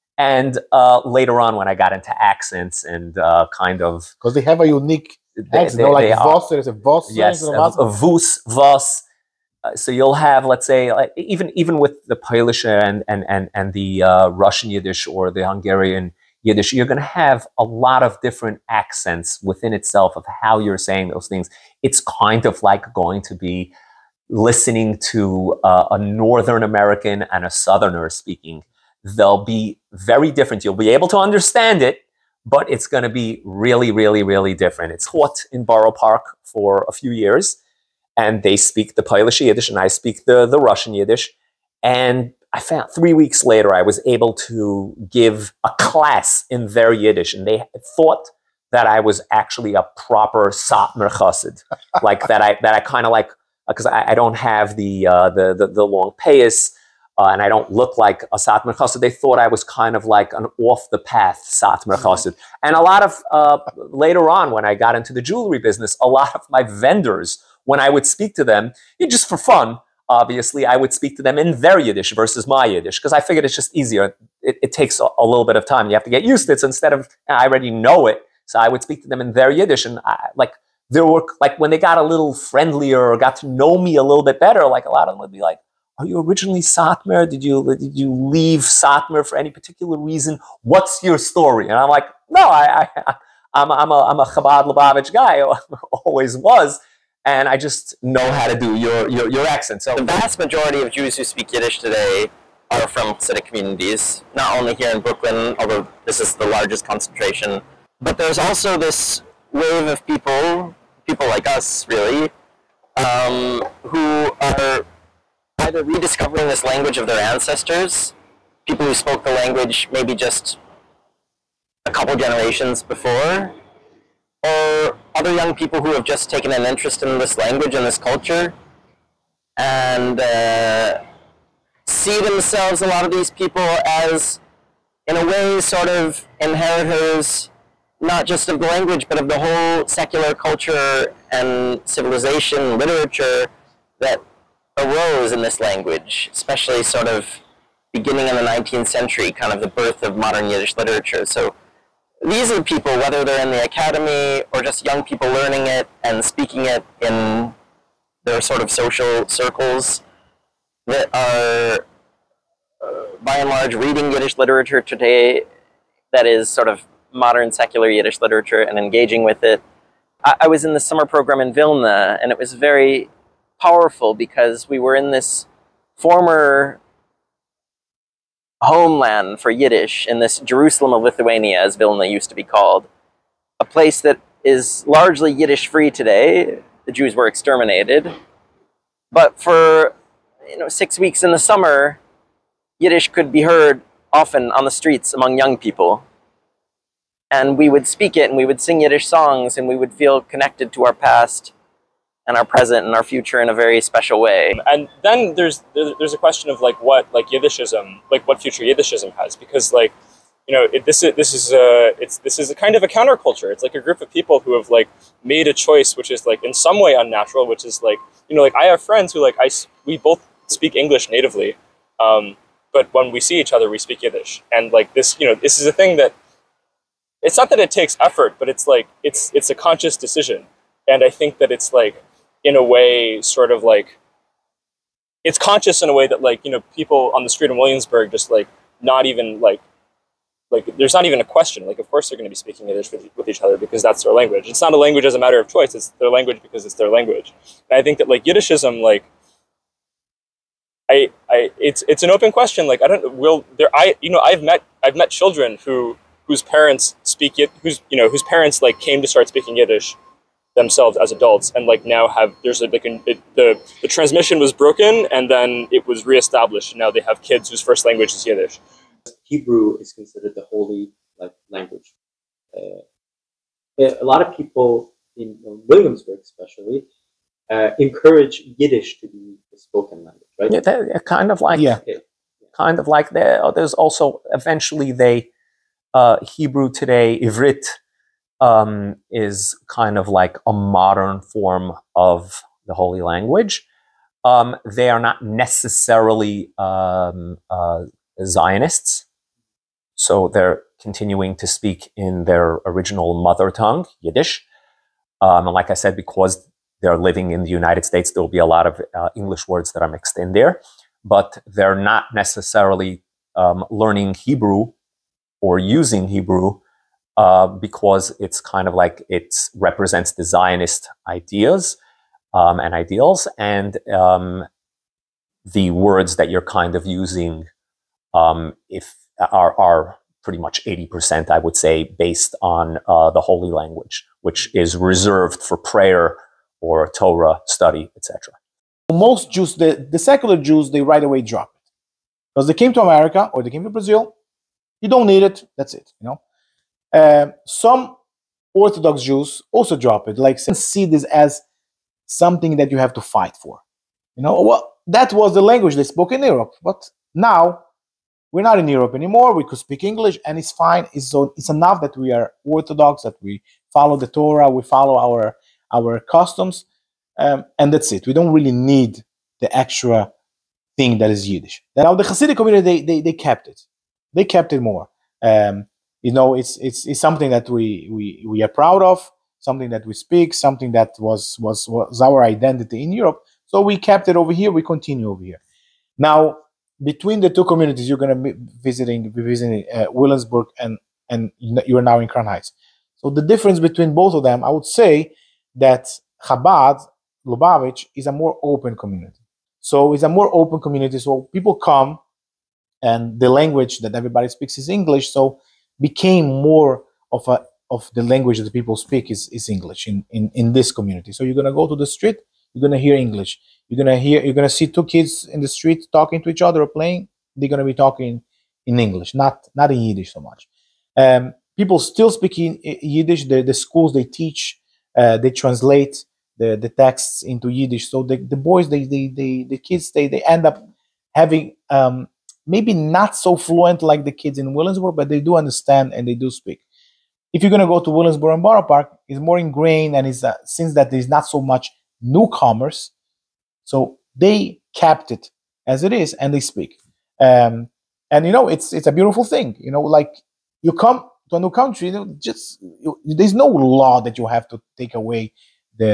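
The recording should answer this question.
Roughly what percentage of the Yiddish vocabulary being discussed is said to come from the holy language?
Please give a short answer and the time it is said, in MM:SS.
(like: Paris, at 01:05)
80%, at 05:30.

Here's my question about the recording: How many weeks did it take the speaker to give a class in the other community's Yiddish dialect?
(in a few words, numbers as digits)
3.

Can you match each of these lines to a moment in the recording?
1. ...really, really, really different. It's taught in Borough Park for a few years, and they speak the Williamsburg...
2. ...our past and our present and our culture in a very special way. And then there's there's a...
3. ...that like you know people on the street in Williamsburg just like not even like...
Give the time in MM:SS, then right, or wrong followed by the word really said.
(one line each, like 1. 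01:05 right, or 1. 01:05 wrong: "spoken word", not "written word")
1. 00:33 wrong: "Polish", not "Williamsburg"
2. 03:20 wrong: "future", not "culture"
3. 03:56 right.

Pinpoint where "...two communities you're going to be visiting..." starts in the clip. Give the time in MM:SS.
06:27.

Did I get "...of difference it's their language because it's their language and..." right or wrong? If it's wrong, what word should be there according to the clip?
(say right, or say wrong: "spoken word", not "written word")
wrong: "choice", not "difference".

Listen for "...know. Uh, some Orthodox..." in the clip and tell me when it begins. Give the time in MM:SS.
05:46.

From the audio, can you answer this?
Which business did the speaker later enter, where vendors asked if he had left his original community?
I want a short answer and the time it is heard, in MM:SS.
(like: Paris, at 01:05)
jewelry, at 01:05.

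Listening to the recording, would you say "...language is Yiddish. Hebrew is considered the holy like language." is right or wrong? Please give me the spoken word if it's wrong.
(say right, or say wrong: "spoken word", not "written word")
right.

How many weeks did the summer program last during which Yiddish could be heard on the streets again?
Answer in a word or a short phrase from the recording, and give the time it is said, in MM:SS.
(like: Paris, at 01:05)
6, at 03:10.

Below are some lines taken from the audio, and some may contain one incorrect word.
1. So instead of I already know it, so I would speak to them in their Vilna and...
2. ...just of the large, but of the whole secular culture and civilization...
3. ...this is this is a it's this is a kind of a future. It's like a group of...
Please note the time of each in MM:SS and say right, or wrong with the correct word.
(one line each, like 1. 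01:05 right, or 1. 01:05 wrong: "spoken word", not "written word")
1. 01:16 wrong: "Yiddish", not "Vilna"
2. 02:18 wrong: "language", not "large"
3. 03:30 wrong: "counterculture", not "future".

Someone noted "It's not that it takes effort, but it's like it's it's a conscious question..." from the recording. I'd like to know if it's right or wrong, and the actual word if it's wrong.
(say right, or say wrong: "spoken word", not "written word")
wrong: "decision", not "question".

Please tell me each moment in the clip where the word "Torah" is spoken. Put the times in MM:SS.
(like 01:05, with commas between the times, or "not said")
05:36, 06:04.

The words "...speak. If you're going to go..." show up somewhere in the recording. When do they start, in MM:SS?
07:16.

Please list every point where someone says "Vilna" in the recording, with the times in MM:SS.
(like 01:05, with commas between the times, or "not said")
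02:51, 03:01.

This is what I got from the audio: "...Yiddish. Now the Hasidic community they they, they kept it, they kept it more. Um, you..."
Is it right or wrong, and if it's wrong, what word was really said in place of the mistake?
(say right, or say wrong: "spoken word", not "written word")
right.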